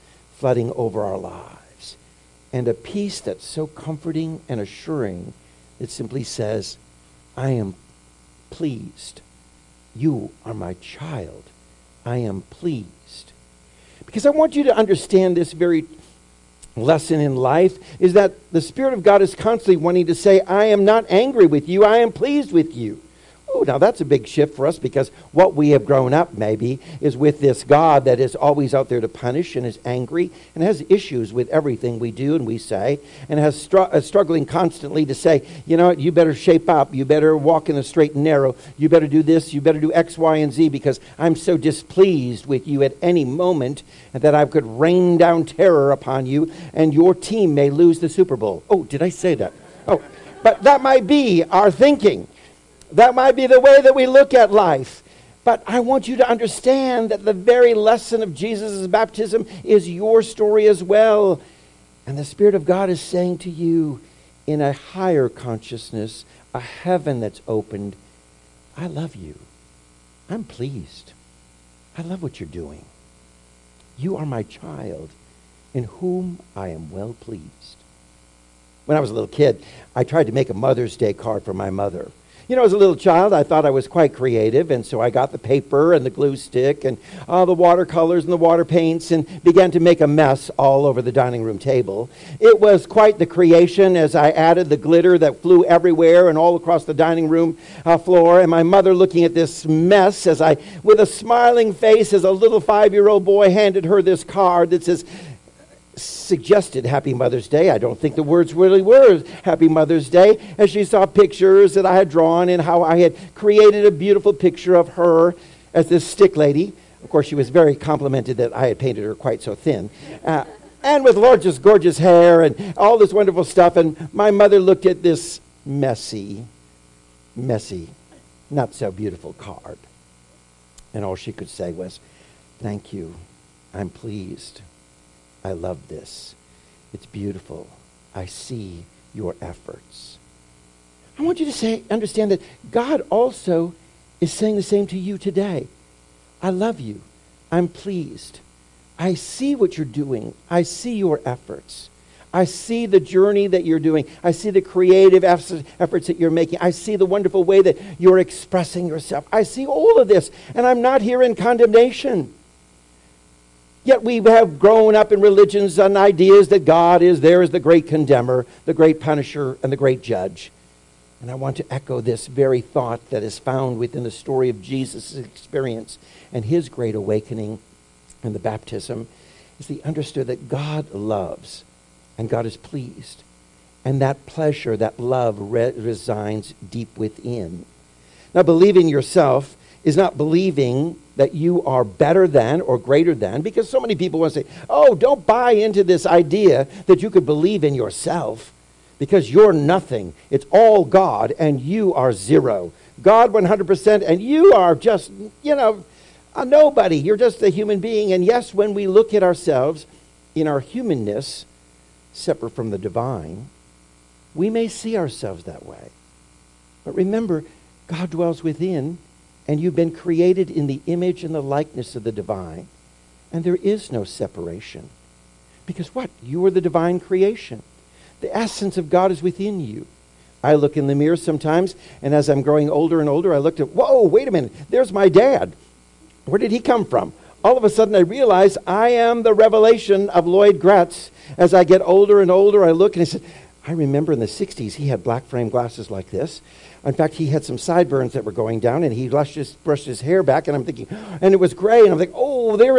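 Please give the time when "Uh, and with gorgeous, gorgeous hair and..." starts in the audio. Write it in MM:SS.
02:00.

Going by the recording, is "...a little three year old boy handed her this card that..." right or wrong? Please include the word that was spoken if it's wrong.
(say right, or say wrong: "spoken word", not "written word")
wrong: "five", not "three".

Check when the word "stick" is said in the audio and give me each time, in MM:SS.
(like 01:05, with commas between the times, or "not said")
01:26, 01:56.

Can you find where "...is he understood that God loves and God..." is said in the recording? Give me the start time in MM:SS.
02:59.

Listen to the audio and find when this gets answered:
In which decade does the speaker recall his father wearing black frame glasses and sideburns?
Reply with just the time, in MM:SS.
04:04.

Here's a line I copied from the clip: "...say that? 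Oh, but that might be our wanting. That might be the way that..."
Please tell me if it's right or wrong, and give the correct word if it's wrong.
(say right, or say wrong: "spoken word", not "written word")
wrong: "thinking", not "wanting".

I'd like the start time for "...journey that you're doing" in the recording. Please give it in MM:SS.
02:32.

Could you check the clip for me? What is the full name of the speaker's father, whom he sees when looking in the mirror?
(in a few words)
Lloyd Graetz.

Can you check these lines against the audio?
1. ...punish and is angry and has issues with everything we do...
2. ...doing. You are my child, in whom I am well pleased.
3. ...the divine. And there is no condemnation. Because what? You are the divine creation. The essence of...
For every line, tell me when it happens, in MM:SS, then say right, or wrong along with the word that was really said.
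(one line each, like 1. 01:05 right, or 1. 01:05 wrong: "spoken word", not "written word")
1. 00:29 right
2. 01:12 right
3. 03:42 wrong: "separation", not "condemnation".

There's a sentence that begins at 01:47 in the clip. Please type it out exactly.
I don't think the words really were Happy Mother's Day.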